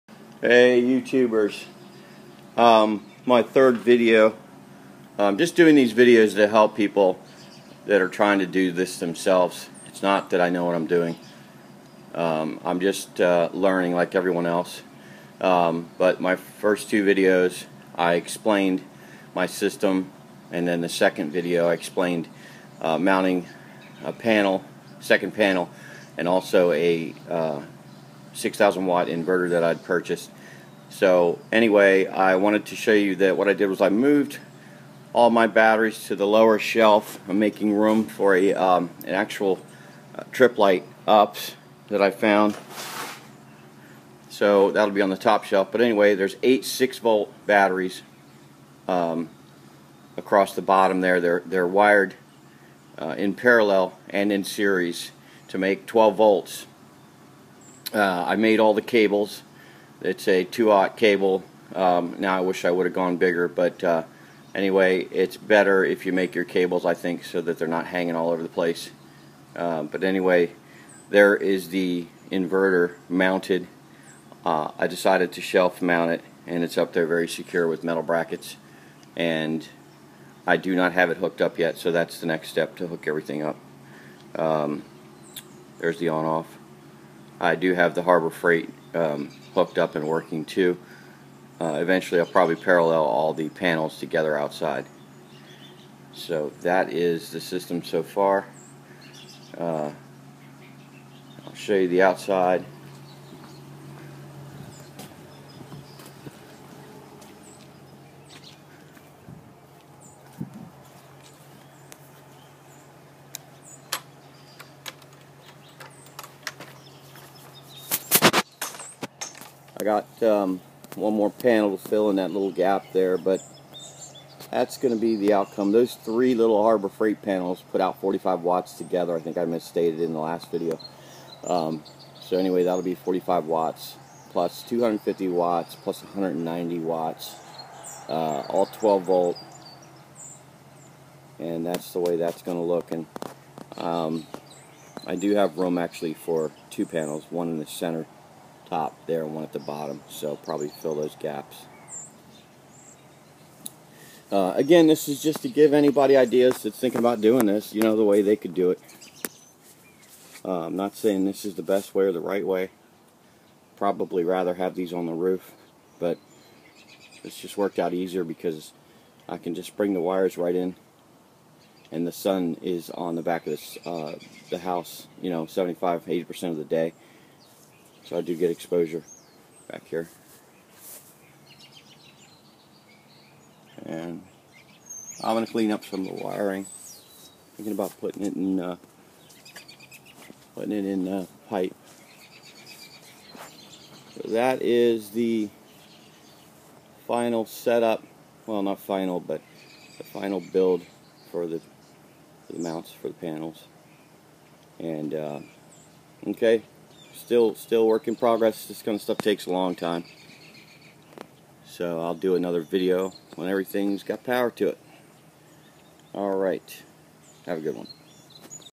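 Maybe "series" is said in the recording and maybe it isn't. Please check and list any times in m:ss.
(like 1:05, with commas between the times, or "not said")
0:54.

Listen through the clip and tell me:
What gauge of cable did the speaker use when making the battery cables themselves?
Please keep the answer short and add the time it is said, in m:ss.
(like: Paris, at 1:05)
2-aught, at 1:00.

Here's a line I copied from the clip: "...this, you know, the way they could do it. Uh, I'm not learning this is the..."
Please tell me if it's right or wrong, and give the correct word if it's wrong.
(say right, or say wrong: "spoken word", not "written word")
wrong: "saying", not "learning".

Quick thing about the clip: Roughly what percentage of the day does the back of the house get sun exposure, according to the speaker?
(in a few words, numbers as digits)
75-80%.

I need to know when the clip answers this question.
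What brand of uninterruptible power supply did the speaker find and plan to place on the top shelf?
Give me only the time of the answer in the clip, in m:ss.
0:40.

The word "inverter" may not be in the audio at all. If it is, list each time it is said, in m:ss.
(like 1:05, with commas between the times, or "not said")
0:29, 1:12.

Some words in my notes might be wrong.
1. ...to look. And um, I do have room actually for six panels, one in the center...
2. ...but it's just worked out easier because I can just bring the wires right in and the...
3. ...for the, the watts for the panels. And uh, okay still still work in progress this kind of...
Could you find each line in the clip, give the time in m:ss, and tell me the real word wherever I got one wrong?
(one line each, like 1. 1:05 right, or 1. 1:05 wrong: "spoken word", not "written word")
1. 2:22 wrong: "two", not "six"
2. 2:45 right
3. 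3:21 wrong: "mounts", not "watts".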